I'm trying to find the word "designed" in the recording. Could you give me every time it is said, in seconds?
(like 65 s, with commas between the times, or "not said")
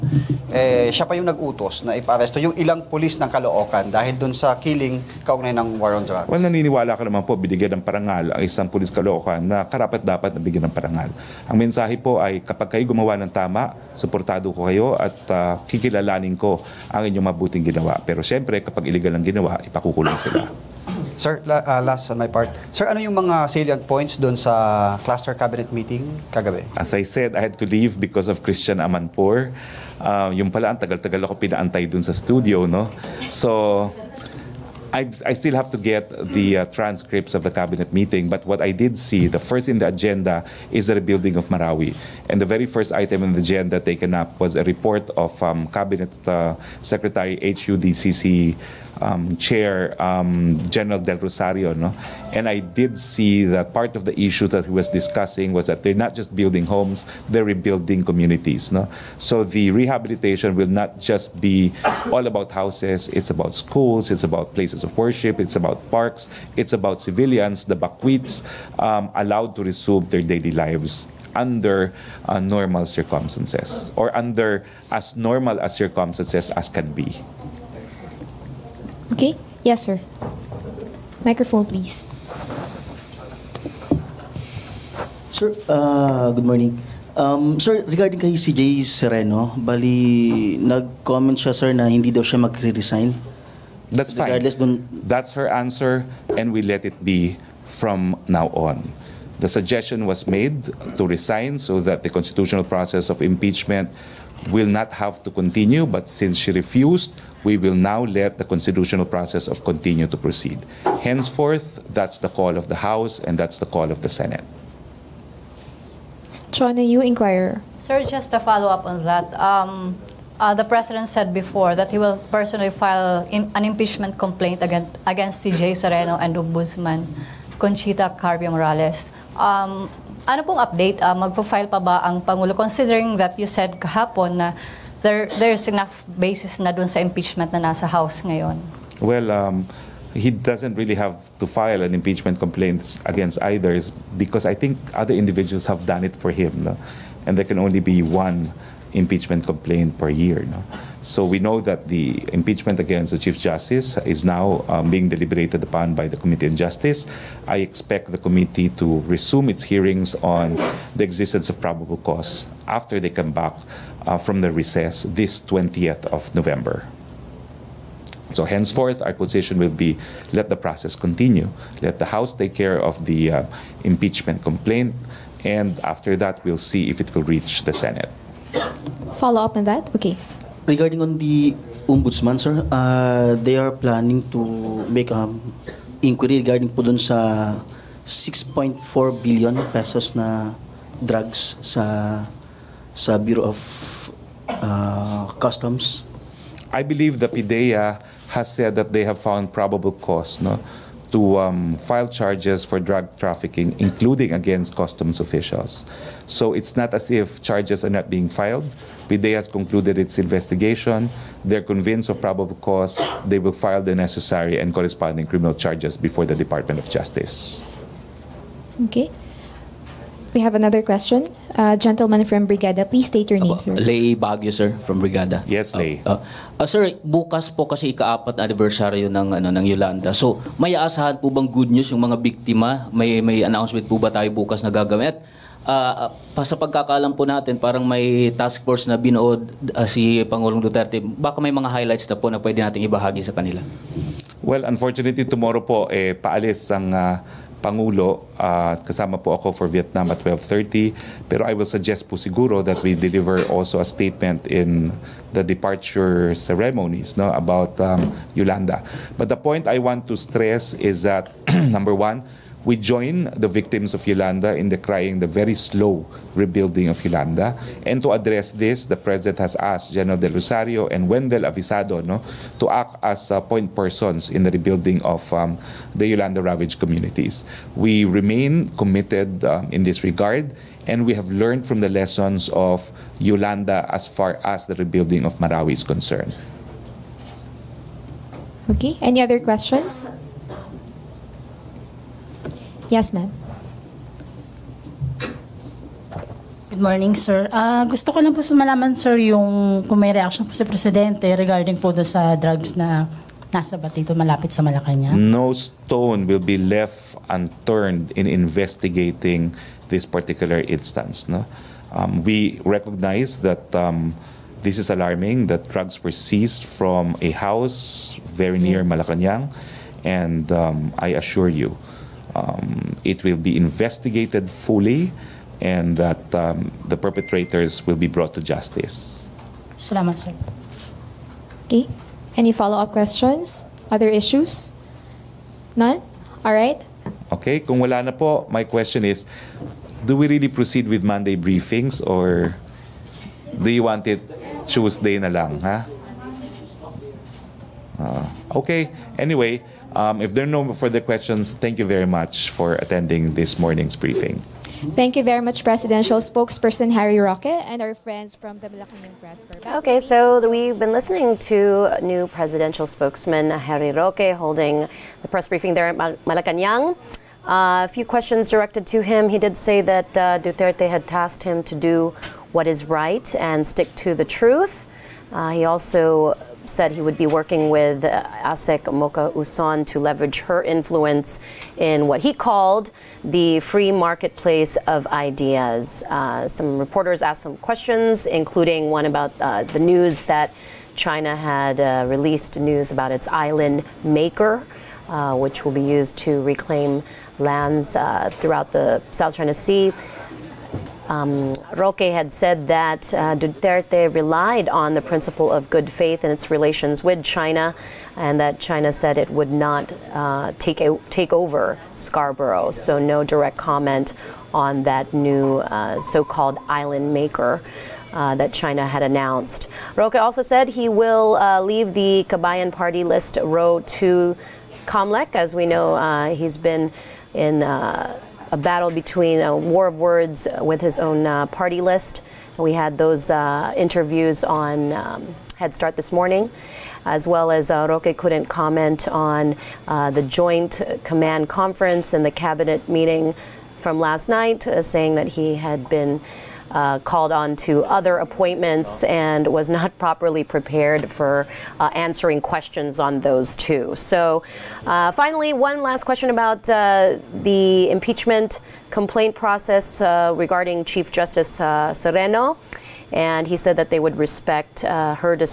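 not said.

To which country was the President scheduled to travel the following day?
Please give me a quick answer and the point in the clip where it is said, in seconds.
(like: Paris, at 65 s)
Vietnam, at 249 s.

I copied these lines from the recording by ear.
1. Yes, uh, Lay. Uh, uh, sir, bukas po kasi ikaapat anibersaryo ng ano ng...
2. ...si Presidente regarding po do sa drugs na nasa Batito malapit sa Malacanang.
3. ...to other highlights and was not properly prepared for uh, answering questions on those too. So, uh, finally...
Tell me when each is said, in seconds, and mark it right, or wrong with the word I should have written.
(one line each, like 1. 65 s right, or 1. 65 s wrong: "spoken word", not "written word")
1. 225 s right
2. 300 s right
3. 447 s wrong: "appointments", not "highlights".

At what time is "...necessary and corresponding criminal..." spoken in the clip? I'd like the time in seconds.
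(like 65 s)
213 s.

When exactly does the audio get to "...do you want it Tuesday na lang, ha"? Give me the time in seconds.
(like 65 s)
343 s.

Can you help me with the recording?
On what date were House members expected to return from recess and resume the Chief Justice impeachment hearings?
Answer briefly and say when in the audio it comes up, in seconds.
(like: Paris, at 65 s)
November 20, at 165 s.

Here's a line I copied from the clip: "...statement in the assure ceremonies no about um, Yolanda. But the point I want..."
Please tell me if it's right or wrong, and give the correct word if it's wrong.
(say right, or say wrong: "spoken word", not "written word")
wrong: "departure", not "assure".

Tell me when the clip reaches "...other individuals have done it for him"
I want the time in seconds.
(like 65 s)
144 s.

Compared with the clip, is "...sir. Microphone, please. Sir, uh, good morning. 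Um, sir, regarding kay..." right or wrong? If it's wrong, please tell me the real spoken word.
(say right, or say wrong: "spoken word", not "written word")
right.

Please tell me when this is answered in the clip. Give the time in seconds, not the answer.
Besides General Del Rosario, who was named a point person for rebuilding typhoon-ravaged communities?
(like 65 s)
271 s.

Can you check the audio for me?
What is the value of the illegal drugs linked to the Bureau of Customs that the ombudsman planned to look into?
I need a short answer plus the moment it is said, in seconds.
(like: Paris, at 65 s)
6.4 billion pesos, at 188 s.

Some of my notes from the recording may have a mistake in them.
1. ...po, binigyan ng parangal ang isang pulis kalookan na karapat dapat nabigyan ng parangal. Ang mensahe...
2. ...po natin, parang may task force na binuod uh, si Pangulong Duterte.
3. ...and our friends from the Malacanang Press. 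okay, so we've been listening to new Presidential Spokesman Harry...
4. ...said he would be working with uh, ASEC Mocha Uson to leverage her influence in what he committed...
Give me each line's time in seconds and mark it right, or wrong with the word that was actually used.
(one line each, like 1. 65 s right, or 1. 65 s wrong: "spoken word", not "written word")
1. 7 s right
2. 237 s right
3. 357 s right
4. 376 s wrong: "called", not "committed".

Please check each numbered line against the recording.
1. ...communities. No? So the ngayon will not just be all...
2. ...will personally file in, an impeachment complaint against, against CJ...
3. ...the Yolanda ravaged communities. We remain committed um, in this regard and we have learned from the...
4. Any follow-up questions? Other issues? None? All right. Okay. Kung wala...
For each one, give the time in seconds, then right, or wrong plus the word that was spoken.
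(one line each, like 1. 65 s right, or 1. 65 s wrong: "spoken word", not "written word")
1. 58 s wrong: "rehabilitation", not "ngayon"
2. 121 s right
3. 275 s right
4. 332 s right.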